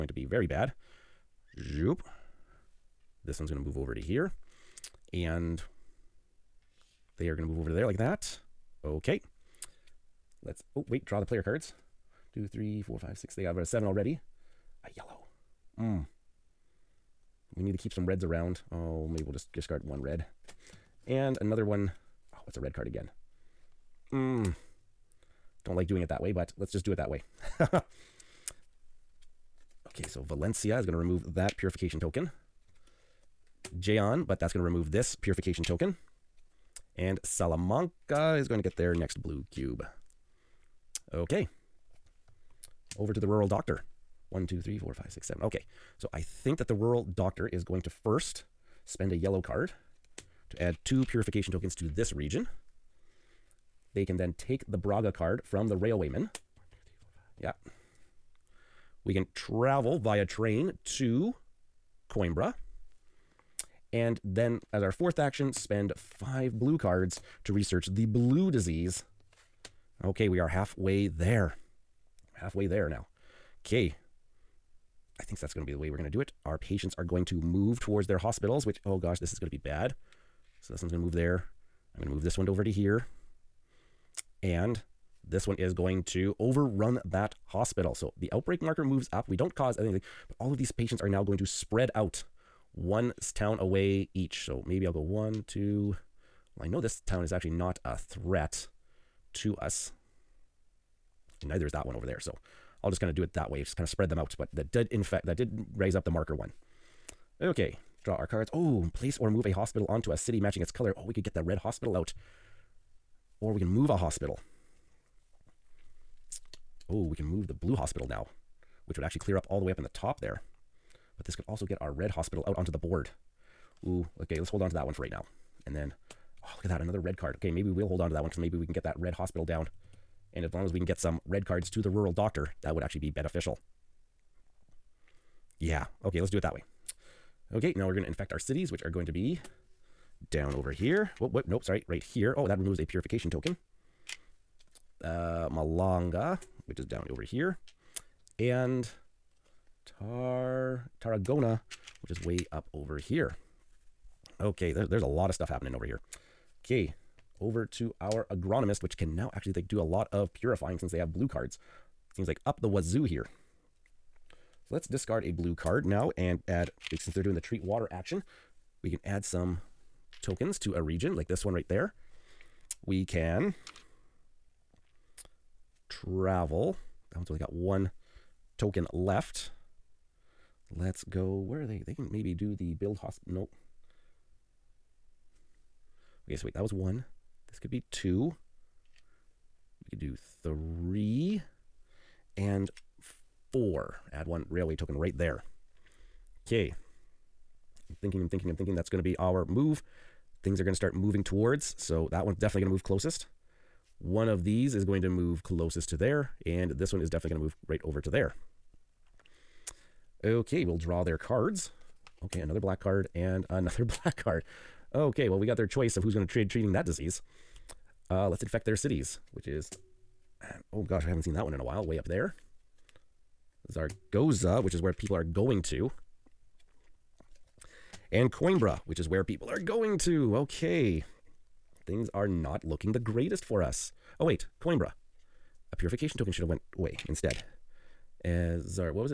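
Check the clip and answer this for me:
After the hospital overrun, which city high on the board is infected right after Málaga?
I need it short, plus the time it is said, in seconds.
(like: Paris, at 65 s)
Tarragona, at 150 s.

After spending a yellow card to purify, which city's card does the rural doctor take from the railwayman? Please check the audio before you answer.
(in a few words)
Braga.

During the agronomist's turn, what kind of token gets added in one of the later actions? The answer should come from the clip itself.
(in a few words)
railway token.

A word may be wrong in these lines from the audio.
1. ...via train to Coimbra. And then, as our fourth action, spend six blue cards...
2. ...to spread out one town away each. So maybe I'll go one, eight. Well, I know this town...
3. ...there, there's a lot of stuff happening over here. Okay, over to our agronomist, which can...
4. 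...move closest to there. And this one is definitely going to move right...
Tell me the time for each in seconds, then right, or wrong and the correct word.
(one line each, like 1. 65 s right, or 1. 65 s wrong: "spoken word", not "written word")
1. 59 s wrong: "five", not "six"
2. 91 s wrong: "two", not "eight"
3. 154 s right
4. 205 s right.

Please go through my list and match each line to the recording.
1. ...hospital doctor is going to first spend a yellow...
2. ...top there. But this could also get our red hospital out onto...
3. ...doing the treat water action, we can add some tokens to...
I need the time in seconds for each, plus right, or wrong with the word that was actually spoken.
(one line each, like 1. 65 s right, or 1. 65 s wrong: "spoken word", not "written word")
1. 46 s wrong: "rural", not "hospital"
2. 119 s right
3. 167 s right.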